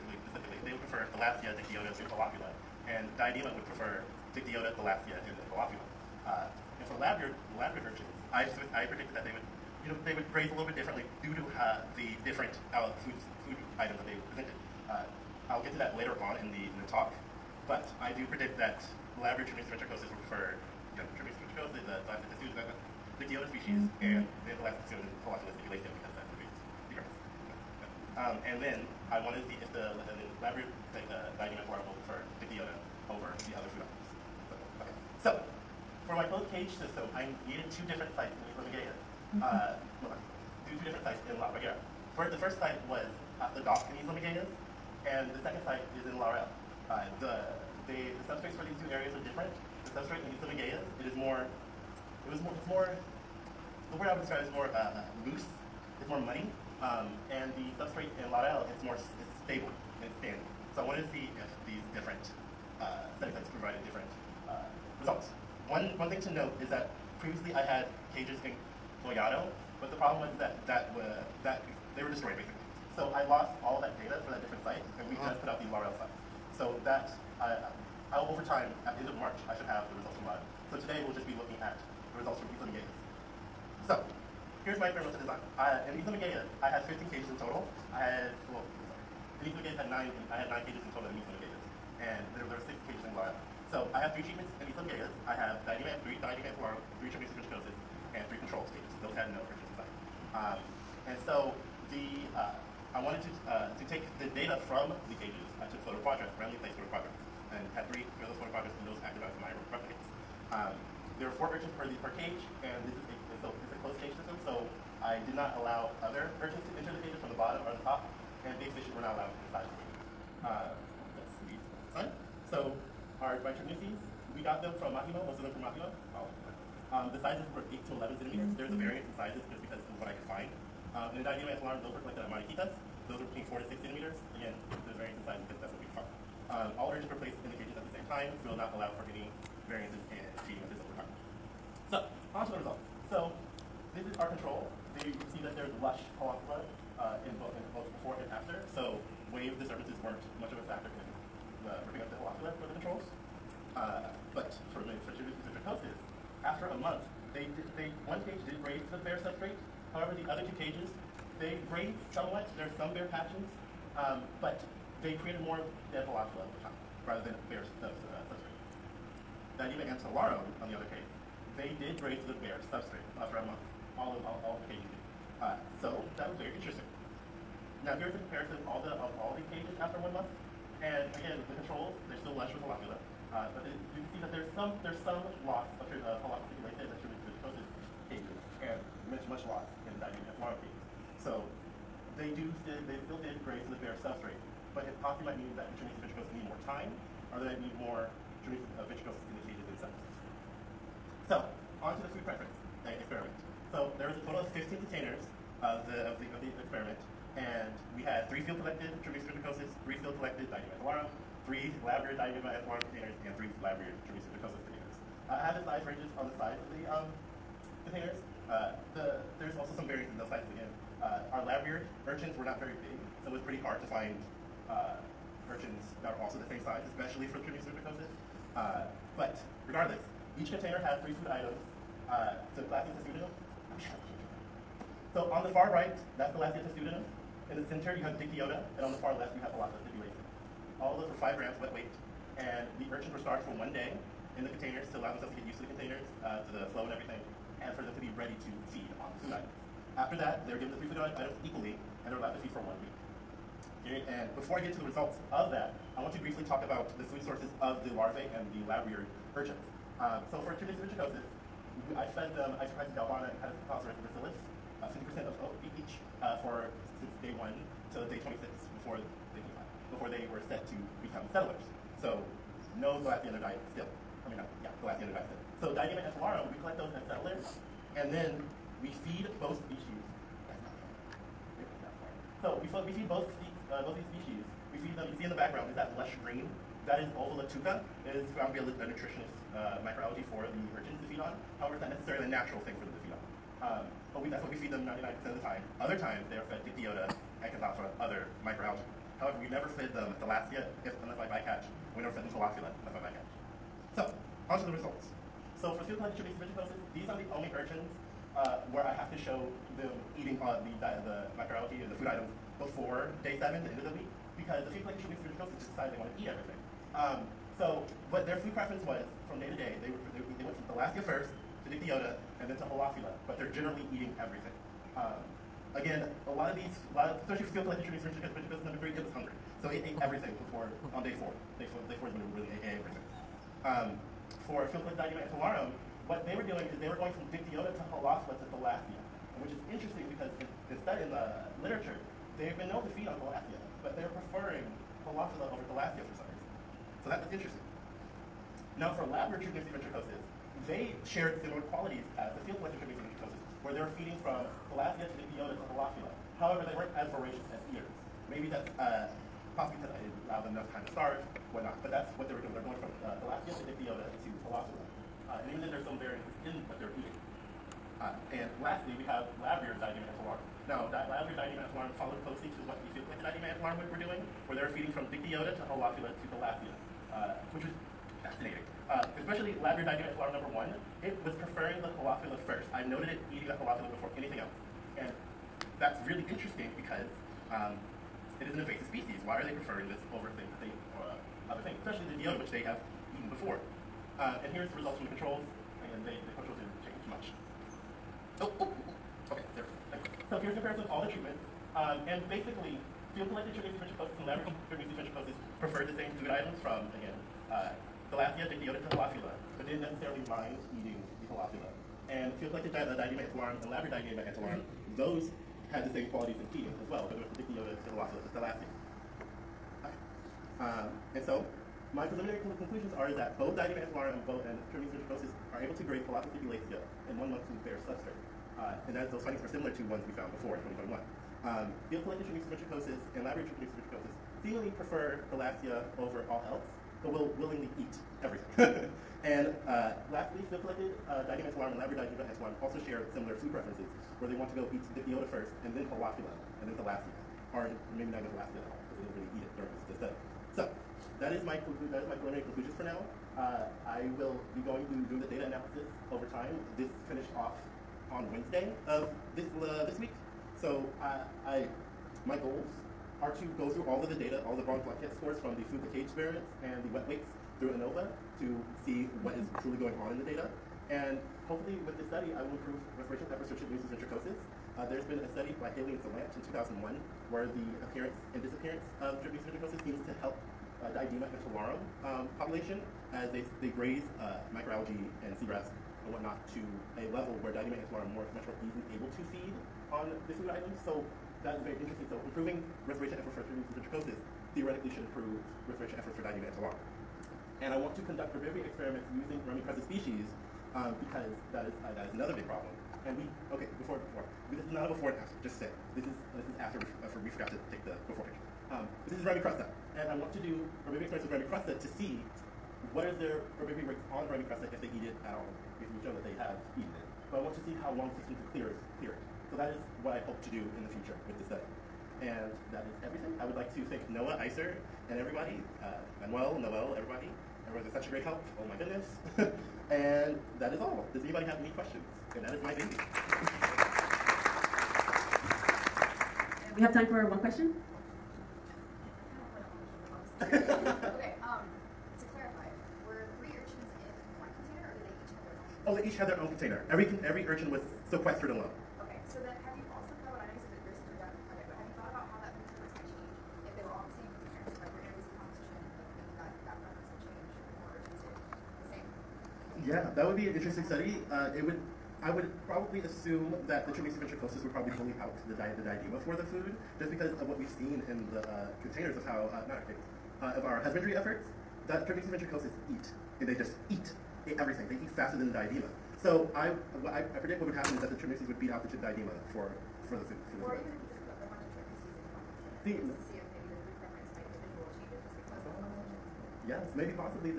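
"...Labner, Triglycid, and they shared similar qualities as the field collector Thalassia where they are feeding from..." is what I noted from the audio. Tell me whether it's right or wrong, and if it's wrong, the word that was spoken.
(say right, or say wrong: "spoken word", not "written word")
wrong: "Triglycid", not "Thalassia".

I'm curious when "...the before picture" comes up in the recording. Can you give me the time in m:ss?
8:27.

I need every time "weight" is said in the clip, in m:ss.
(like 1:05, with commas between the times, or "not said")
4:01, 7:47.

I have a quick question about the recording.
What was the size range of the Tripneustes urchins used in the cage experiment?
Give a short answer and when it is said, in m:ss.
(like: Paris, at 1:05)
8 to 11 centimeters, at 2:07.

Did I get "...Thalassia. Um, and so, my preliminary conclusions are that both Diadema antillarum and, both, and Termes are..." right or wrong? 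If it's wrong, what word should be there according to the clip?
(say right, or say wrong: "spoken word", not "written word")
right.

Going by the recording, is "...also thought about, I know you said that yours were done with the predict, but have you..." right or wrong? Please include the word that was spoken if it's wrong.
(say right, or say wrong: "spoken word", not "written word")
wrong: "project", not "predict".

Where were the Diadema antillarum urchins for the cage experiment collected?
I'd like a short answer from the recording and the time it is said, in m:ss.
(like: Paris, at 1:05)
Mariquitas, at 2:12.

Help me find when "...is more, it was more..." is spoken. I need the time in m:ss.
0:51.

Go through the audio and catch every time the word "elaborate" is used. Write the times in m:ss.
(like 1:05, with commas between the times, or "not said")
0:19, 0:30.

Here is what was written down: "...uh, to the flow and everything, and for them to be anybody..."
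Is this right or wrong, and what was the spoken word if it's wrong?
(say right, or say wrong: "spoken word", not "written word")
wrong: "ready", not "anybody".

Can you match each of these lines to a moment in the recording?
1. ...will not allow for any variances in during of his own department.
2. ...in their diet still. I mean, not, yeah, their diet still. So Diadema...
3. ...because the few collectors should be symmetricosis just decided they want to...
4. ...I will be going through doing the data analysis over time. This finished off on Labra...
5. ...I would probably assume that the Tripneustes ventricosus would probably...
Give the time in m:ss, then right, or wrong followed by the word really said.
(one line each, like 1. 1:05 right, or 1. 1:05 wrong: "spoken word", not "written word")
1. 2:18 wrong: "cheating", not "during"
2. 4:32 right
3. 5:14 right
4. 7:33 wrong: "Wednesday", not "Labra"
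5. 9:22 right.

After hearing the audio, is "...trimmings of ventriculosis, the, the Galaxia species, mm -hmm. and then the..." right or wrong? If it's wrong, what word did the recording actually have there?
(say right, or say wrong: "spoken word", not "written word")
wrong: "Dictyota", not "Galaxia".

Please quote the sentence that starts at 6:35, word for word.
Again, they, the controls didn't change much.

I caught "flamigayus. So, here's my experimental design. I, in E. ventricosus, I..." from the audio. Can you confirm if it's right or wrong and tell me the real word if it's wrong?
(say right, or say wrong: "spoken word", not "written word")
wrong: "flamigayus", not "ventricosus".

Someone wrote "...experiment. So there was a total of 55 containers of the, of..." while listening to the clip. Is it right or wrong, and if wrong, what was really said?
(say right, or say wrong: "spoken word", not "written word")
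wrong: "15", not "55".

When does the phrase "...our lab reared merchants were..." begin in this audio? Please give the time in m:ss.
3:41.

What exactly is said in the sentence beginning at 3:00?
And again, the controls, they're still lush with holopula.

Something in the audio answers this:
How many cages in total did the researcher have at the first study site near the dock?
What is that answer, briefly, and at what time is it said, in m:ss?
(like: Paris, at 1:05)
9, at 1:30.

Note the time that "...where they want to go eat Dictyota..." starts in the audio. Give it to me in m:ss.
7:24.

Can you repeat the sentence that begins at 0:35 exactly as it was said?
So, for my closed cage system, I needed two different sites in East Lamagea.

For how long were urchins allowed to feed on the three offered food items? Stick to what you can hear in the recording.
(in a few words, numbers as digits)
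one week.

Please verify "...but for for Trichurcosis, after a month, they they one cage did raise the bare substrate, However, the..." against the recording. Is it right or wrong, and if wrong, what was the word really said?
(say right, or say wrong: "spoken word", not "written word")
right.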